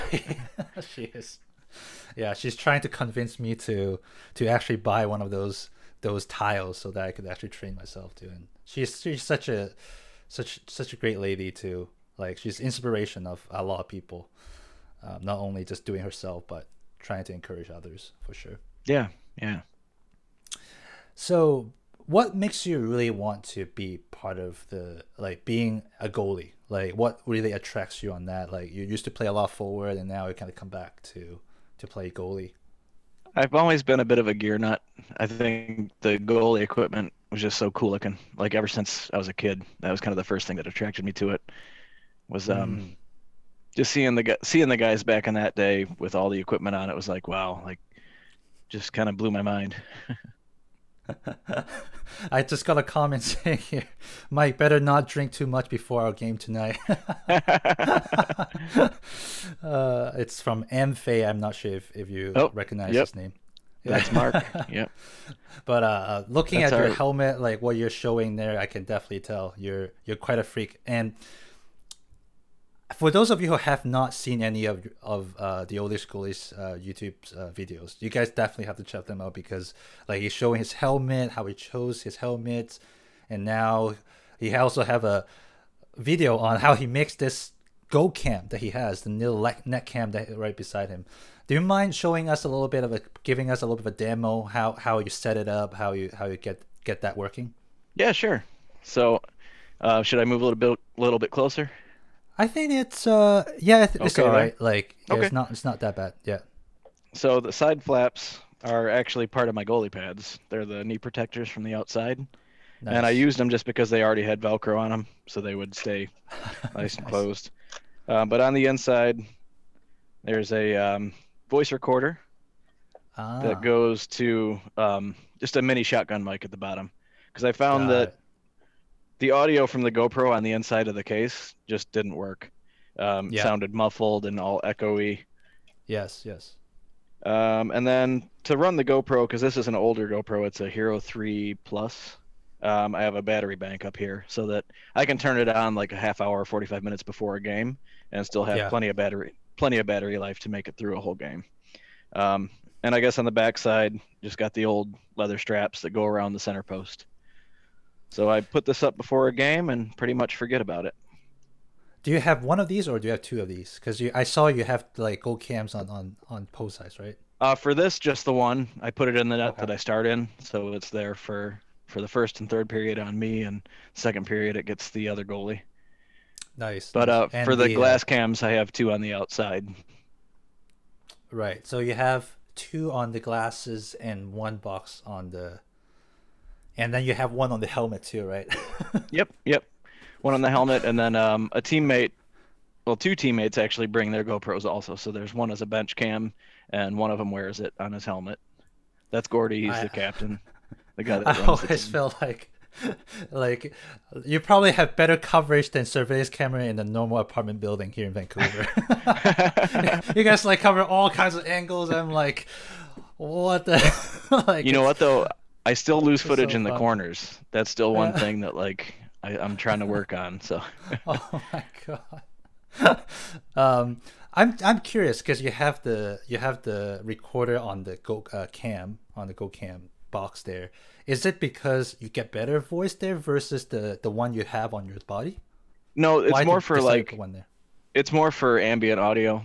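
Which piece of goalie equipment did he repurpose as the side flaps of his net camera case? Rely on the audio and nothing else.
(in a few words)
knee protectors.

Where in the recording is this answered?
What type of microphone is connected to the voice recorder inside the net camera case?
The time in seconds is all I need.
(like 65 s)
125 s.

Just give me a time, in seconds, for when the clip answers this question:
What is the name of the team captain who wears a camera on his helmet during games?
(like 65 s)
199 s.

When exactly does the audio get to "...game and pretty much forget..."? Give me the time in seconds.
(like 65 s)
159 s.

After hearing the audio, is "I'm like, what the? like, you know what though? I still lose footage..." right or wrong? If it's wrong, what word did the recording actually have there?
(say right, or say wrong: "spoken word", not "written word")
right.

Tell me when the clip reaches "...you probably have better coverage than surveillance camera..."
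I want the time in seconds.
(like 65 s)
204 s.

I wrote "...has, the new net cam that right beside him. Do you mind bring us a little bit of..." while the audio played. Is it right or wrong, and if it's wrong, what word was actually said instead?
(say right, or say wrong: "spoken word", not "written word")
wrong: "showing", not "bring".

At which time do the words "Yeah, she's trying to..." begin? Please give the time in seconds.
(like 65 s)
2 s.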